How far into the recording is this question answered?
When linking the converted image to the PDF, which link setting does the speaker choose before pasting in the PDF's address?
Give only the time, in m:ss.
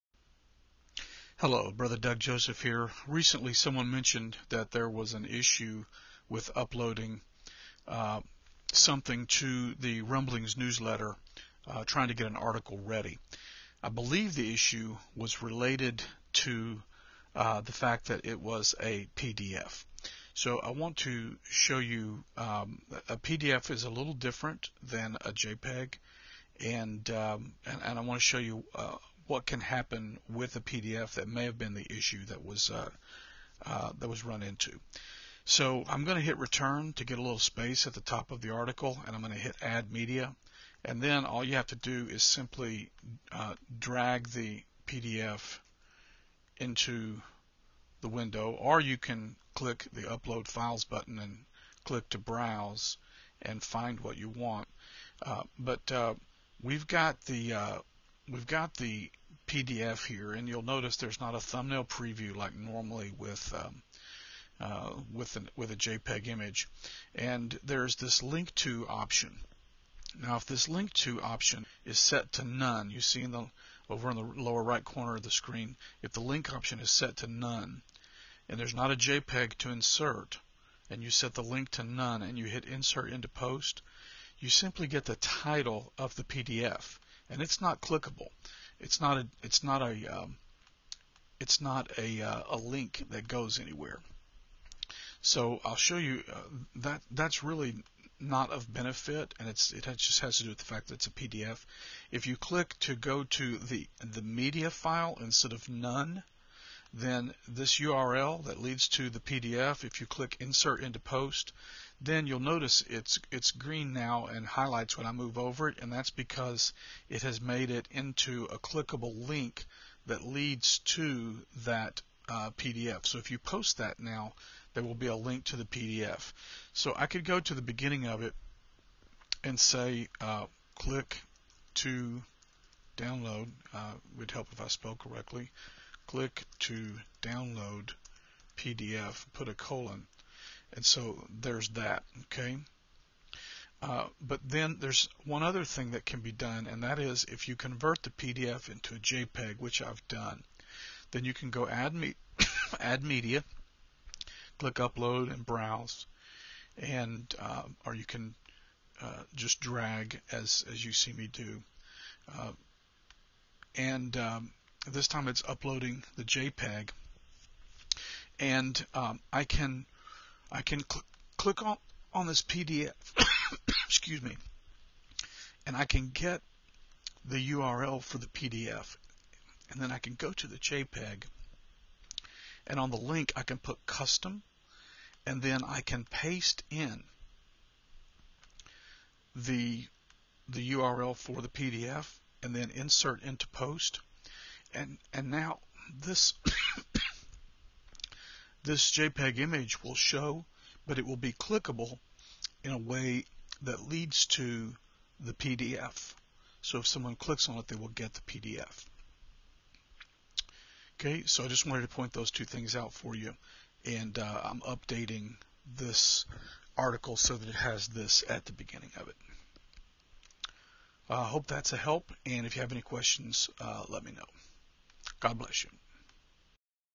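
3:03.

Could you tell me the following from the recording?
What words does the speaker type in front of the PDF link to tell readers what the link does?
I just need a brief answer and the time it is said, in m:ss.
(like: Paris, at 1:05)
Click to download PDF, at 2:16.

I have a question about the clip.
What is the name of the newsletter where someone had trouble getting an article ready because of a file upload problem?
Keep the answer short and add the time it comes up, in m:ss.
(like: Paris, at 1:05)
Rumblings, at 0:10.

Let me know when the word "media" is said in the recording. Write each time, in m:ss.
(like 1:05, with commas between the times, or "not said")
0:39, 1:44, 2:33.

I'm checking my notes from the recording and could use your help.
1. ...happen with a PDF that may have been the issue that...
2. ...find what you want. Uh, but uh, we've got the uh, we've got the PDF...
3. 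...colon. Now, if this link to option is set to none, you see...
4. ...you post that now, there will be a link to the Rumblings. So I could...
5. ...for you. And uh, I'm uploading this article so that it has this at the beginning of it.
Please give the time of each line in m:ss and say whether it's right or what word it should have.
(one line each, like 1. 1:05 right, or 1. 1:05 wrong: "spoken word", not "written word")
1. 0:29 right
2. 0:53 right
3. 1:08 wrong: "option", not "colon"
4. 2:03 wrong: "PDF", not "Rumblings"
5. 3:32 wrong: "updating", not "uploading".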